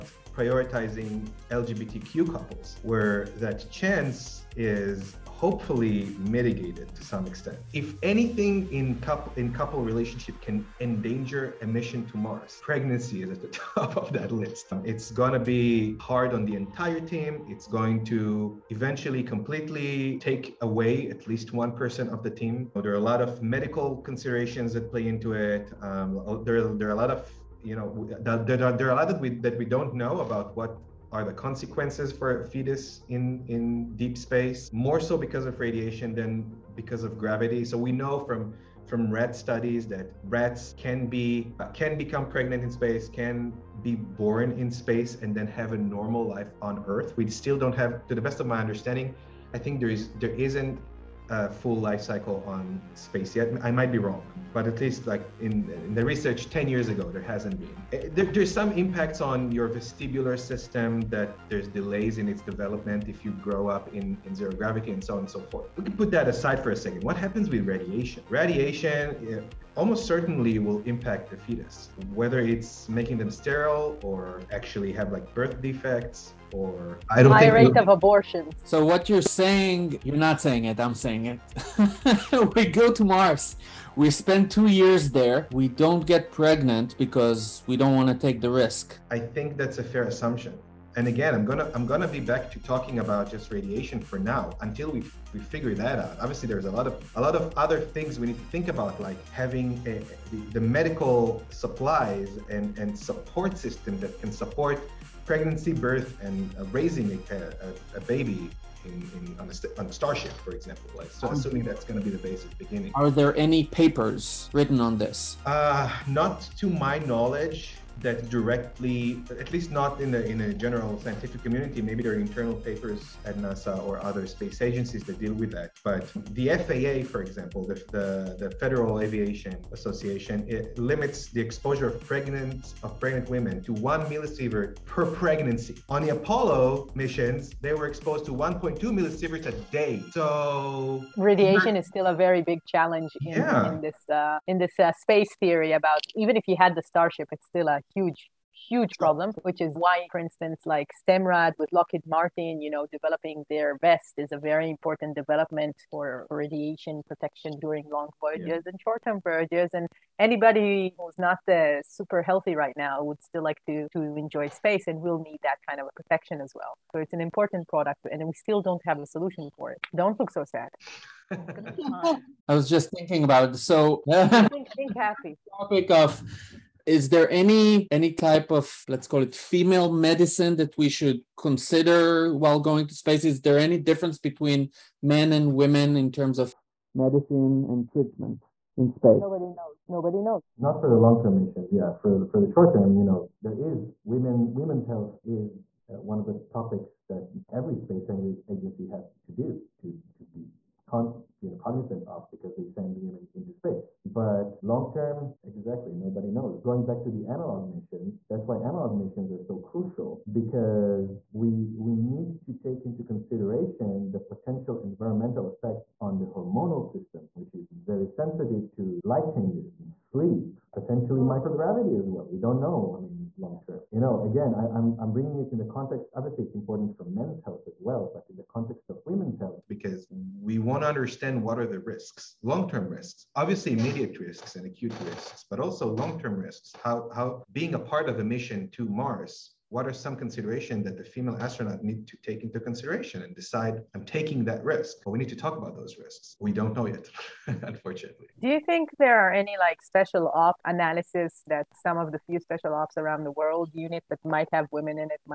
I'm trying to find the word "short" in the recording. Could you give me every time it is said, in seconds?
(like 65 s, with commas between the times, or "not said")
158 s, 192 s.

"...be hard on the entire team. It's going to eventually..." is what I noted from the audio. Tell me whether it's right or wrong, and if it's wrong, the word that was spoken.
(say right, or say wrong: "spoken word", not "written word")
right.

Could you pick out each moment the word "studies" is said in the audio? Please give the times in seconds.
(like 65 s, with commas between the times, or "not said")
39 s.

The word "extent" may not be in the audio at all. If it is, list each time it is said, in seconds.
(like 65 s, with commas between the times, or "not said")
7 s.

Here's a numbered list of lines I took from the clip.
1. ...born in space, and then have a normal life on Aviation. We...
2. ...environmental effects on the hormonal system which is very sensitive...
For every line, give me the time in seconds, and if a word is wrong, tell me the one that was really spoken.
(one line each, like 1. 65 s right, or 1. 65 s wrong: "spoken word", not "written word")
1. 43 s wrong: "Earth", not "Aviation"
2. 214 s right.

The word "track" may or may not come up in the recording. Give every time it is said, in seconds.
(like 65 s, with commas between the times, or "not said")
not said.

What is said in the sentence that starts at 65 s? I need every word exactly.
We can put that aside for a second.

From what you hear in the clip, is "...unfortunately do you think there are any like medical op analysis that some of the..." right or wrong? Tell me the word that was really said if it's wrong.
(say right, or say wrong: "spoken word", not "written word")
wrong: "special", not "medical".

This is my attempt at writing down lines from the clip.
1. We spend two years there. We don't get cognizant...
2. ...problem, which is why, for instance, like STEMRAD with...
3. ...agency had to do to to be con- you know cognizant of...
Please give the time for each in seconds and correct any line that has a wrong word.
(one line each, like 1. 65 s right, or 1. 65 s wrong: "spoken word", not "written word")
1. 83 s wrong: "pregnant", not "cognizant"
2. 148 s right
3. 198 s right.